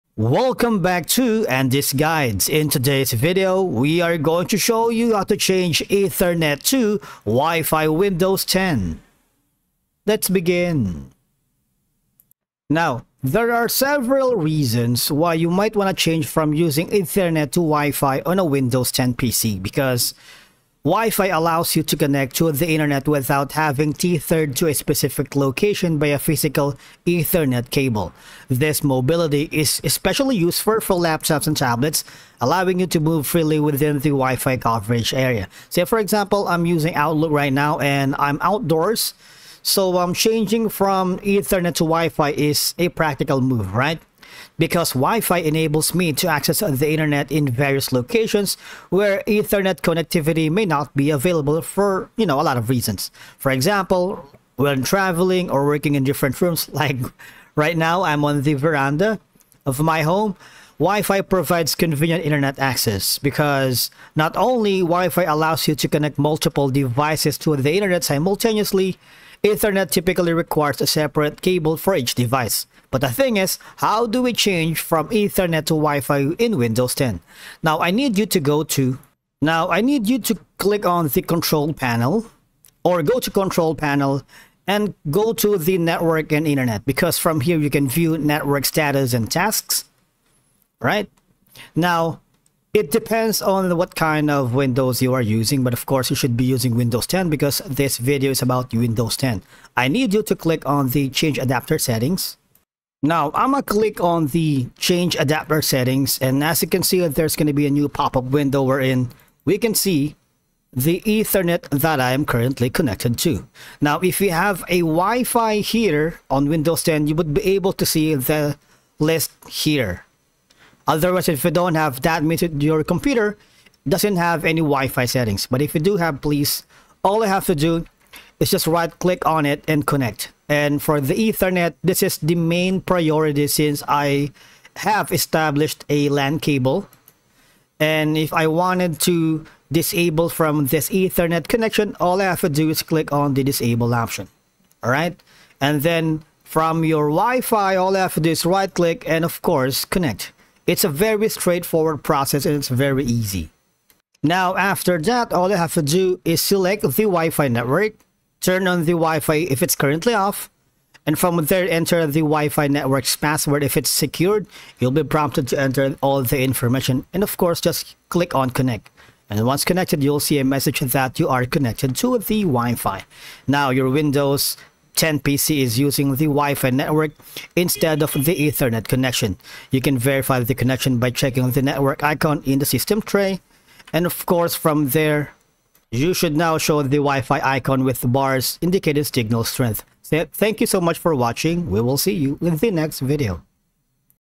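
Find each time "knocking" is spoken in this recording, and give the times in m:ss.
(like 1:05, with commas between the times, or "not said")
not said.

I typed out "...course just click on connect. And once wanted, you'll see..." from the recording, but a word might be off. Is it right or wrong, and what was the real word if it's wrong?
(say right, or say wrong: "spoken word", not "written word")
wrong: "connected", not "wanted".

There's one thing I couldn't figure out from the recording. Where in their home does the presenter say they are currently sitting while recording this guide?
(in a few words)
Veranda.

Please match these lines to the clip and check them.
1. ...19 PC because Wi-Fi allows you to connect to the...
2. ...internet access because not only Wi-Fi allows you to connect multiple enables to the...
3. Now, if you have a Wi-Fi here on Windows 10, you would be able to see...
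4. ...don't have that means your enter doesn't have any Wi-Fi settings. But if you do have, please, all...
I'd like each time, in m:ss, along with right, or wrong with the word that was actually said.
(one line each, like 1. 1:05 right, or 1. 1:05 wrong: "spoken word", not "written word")
1. 0:18 wrong: "10", not "19"
2. 1:02 wrong: "devices", not "enables"
3. 1:53 right
4. 2:01 wrong: "computer", not "enter".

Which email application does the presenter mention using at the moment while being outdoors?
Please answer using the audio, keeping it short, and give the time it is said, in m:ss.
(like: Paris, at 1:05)
Outlook, at 0:36.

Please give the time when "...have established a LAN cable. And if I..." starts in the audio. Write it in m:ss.
2:14.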